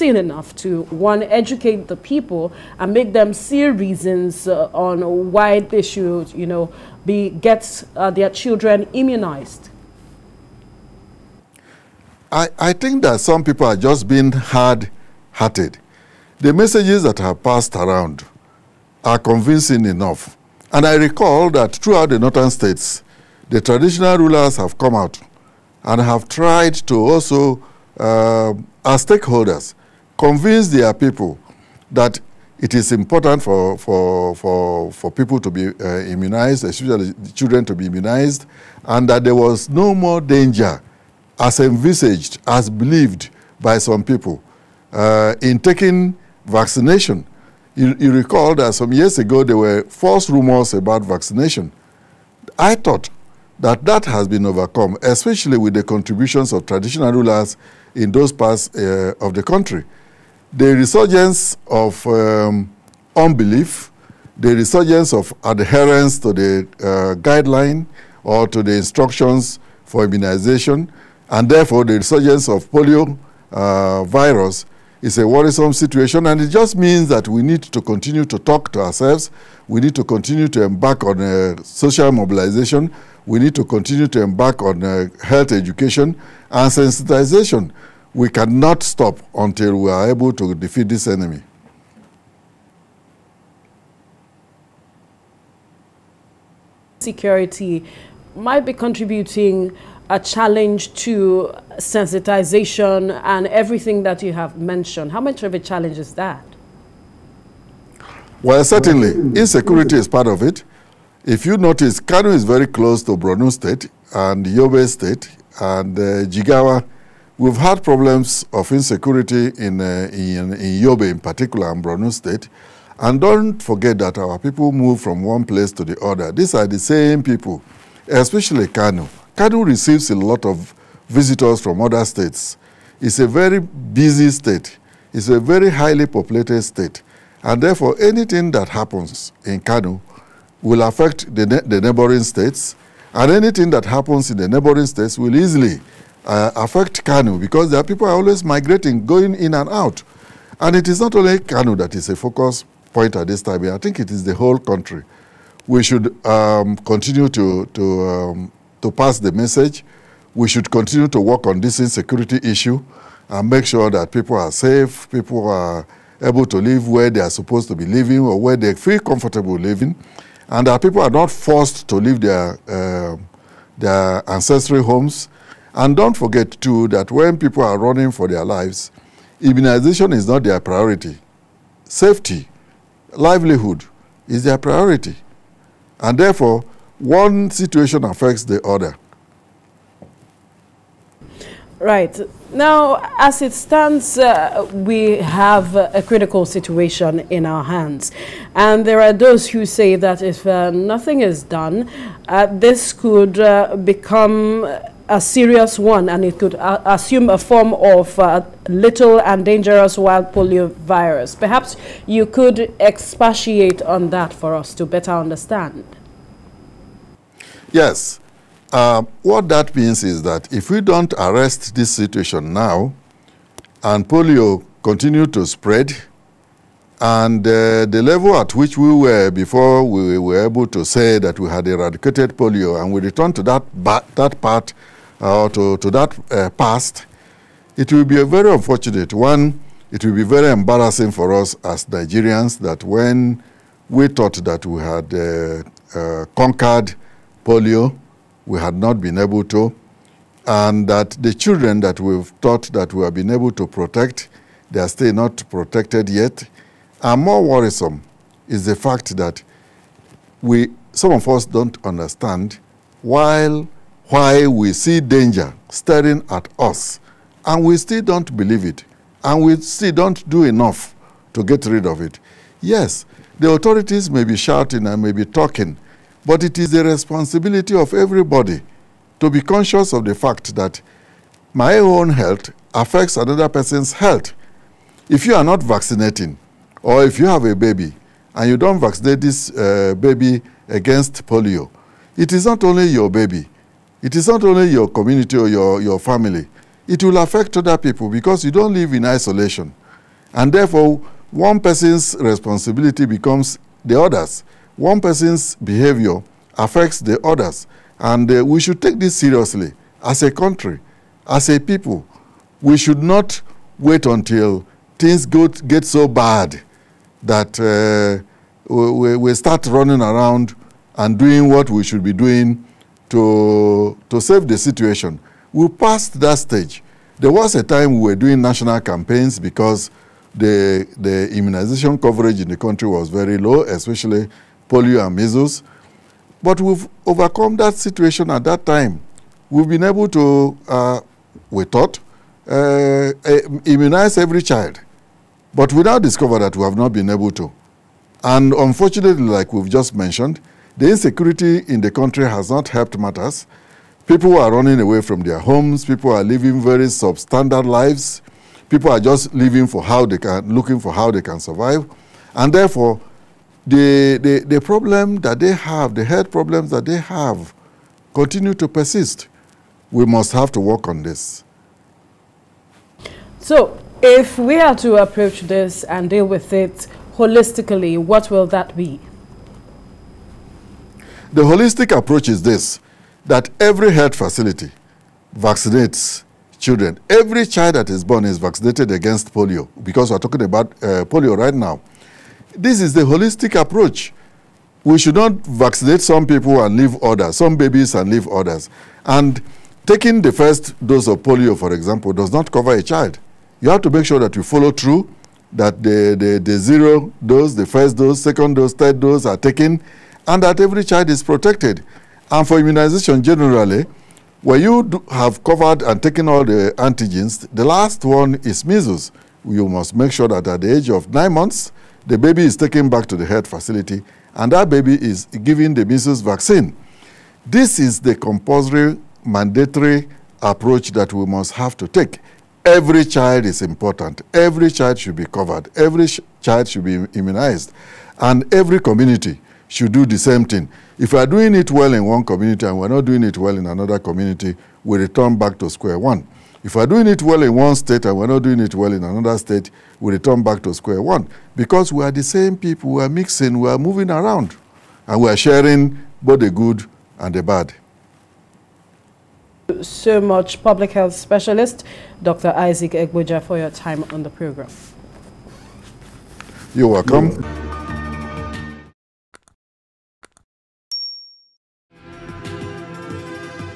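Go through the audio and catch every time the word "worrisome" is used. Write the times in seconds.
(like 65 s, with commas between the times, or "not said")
75 s, 257 s.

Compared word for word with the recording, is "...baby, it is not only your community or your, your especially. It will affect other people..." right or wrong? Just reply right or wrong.
wrong.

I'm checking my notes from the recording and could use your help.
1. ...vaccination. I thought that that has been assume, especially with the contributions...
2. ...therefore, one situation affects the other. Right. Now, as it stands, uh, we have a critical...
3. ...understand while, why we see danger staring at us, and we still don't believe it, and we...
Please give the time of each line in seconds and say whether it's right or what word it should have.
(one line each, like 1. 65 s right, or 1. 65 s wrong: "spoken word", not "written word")
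1. 51 s wrong: "overcome", not "assume"
2. 186 s right
3. 261 s right.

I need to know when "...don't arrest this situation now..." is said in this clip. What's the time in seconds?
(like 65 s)
220 s.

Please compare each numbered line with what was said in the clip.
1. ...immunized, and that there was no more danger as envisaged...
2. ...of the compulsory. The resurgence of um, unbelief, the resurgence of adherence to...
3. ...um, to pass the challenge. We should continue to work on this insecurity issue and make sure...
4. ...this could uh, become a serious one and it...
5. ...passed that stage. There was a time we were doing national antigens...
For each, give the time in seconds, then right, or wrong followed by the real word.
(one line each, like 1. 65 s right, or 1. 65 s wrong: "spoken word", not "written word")
1. 37 s right
2. 59 s wrong: "country", not "compulsory"
3. 158 s wrong: "message", not "challenge"
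4. 202 s right
5. 325 s wrong: "campaigns", not "antigens".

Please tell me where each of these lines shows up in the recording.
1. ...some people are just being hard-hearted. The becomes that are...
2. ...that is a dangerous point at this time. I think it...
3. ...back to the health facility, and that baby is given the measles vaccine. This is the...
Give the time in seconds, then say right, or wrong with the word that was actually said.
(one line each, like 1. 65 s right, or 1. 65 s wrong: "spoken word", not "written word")
1. 13 s wrong: "messages", not "becomes"
2. 151 s wrong: "focus", not "dangerous"
3. 422 s right.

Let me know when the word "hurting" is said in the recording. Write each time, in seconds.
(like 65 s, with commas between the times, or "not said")
not said.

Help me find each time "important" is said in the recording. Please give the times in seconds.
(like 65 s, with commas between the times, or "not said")
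32 s, 433 s.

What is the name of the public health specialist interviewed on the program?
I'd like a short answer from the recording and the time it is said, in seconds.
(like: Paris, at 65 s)
Isaac Egboja, at 462 s.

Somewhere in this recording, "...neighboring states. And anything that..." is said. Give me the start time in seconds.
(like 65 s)
141 s.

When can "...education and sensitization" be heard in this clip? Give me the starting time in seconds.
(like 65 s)
85 s.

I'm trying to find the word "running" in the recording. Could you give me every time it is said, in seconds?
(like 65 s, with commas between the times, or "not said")
177 s, 319 s, 354 s.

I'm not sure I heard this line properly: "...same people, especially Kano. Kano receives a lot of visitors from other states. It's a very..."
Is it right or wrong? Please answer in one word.
right.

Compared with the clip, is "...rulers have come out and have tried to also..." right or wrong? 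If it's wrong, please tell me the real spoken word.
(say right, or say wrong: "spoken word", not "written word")
right.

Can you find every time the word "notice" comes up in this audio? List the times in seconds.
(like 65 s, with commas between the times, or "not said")
111 s.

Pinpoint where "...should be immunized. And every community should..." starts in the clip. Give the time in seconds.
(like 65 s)
436 s.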